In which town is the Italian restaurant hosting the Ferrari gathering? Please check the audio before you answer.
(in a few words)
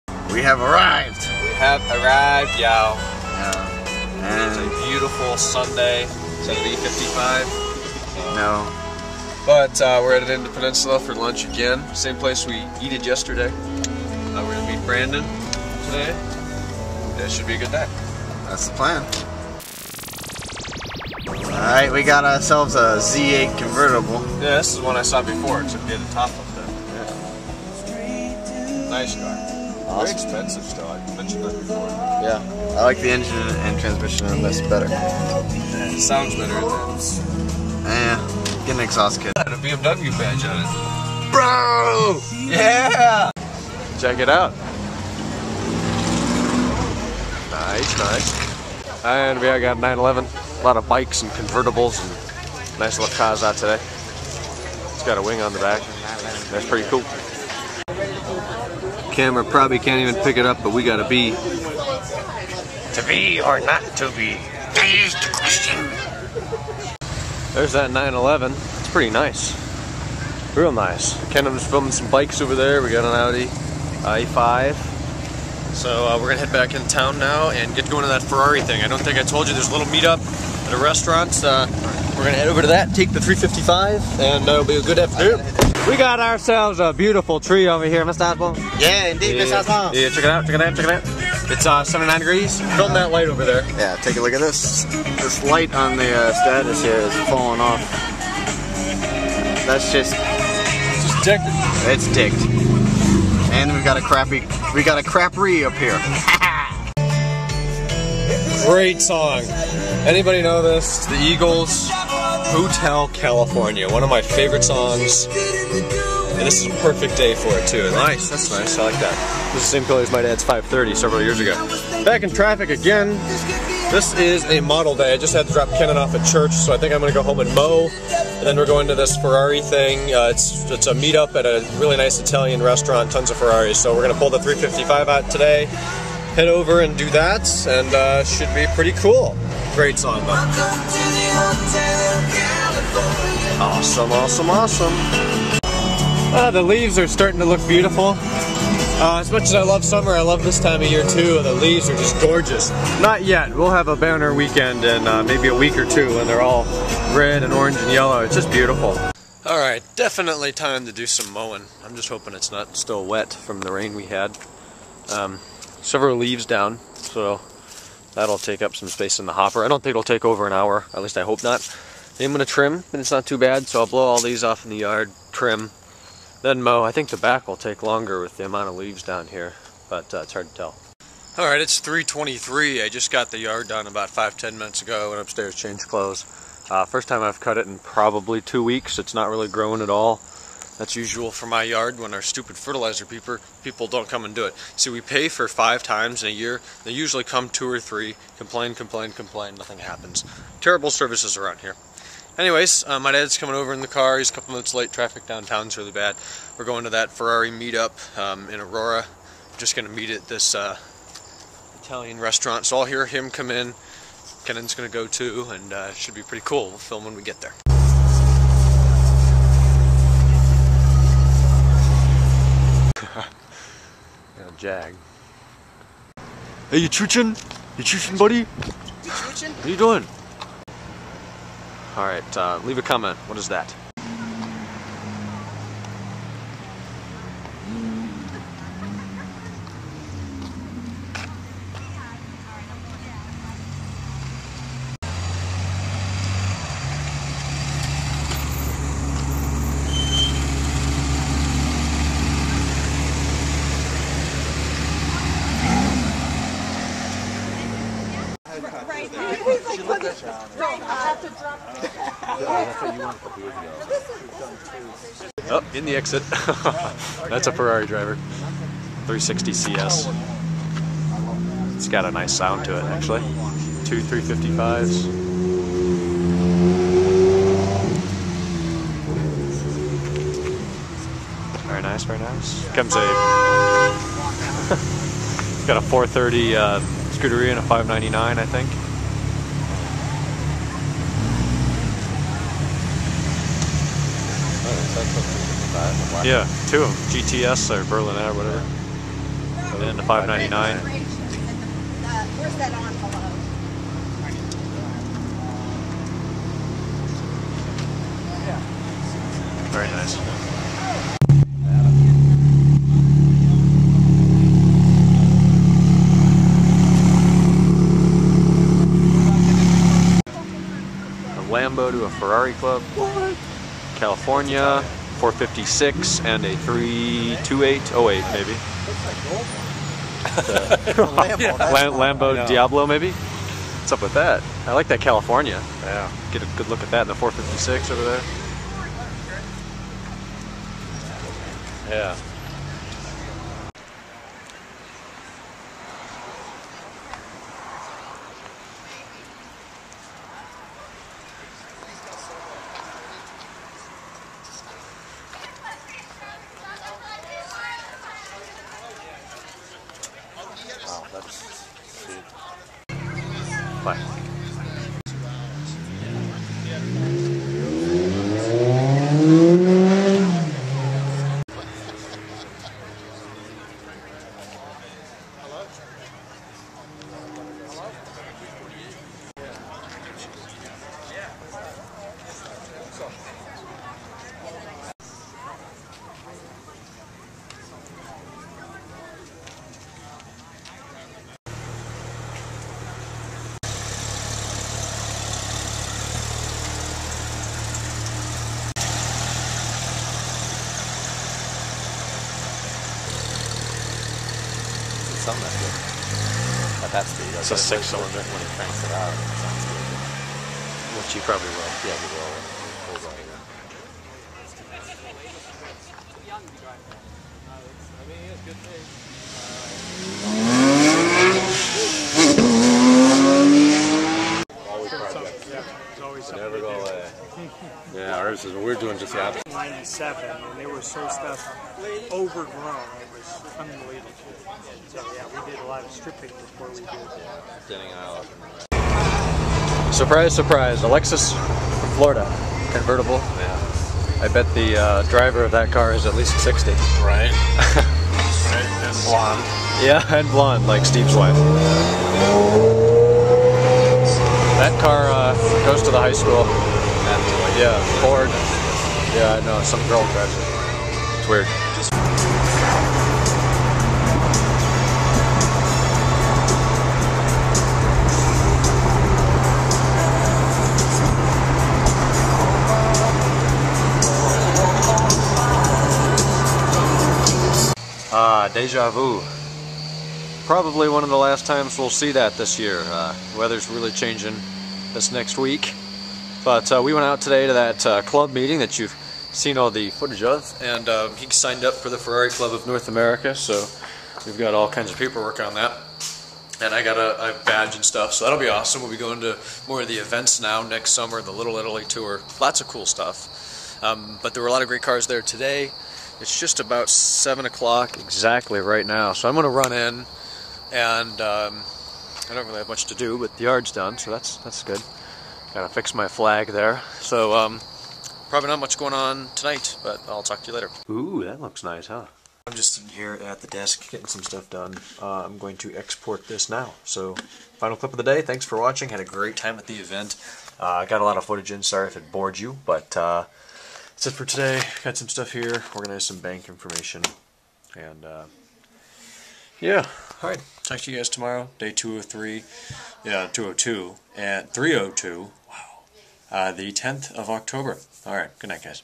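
Aurora.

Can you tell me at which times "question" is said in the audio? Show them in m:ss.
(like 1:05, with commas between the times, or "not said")
1:05.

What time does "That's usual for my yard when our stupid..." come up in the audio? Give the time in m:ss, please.
3:10.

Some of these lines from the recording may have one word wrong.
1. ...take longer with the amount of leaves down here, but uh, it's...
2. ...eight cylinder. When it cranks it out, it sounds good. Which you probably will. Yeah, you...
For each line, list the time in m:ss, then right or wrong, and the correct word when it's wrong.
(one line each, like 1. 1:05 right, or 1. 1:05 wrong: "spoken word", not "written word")
1. 2:57 right
2. 6:47 wrong: "six", not "eight".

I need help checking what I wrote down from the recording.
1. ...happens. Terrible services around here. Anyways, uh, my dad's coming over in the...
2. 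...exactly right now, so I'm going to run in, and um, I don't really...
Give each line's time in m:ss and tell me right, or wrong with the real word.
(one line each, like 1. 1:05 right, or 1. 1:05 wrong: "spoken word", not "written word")
1. 3:19 right
2. 8:27 right.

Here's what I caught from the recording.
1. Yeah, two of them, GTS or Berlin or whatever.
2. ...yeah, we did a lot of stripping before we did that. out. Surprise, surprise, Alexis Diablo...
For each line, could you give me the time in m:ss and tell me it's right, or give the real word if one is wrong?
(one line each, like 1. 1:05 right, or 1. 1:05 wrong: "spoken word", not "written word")
1. 4:56 right
2. 7:15 wrong: "Florida", not "Diablo".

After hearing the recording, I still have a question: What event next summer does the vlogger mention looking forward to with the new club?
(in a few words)
Little Italy tour.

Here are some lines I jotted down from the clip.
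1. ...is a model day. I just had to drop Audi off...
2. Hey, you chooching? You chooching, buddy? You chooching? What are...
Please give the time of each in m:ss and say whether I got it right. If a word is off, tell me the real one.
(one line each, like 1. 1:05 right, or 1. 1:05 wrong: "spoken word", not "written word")
1. 2:04 wrong: "Kenan", not "Audi"
2. 3:46 right.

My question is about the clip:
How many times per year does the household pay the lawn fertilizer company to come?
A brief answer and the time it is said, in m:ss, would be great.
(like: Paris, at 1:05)
5, at 3:15.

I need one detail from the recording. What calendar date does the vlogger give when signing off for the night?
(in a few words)
October 10.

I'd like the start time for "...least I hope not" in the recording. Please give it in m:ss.
2:51.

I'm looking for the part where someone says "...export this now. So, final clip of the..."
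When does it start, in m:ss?
8:45.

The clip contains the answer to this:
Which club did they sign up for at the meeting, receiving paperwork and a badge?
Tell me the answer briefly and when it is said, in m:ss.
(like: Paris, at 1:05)
Ferrari Club of North America, at 8:11.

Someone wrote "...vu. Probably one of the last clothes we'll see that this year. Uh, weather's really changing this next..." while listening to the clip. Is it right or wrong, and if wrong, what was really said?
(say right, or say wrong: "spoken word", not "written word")
wrong: "times", not "clothes".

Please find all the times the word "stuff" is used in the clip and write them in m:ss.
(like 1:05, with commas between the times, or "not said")
7:11, 8:17, 8:22, 8:44, 8:55.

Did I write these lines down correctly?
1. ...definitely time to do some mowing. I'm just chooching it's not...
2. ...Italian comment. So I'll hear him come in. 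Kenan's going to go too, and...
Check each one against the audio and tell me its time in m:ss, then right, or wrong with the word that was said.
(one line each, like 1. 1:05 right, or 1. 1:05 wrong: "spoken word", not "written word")
1. 2:39 wrong: "hoping", not "chooching"
2. 3:31 wrong: "restaurant", not "comment".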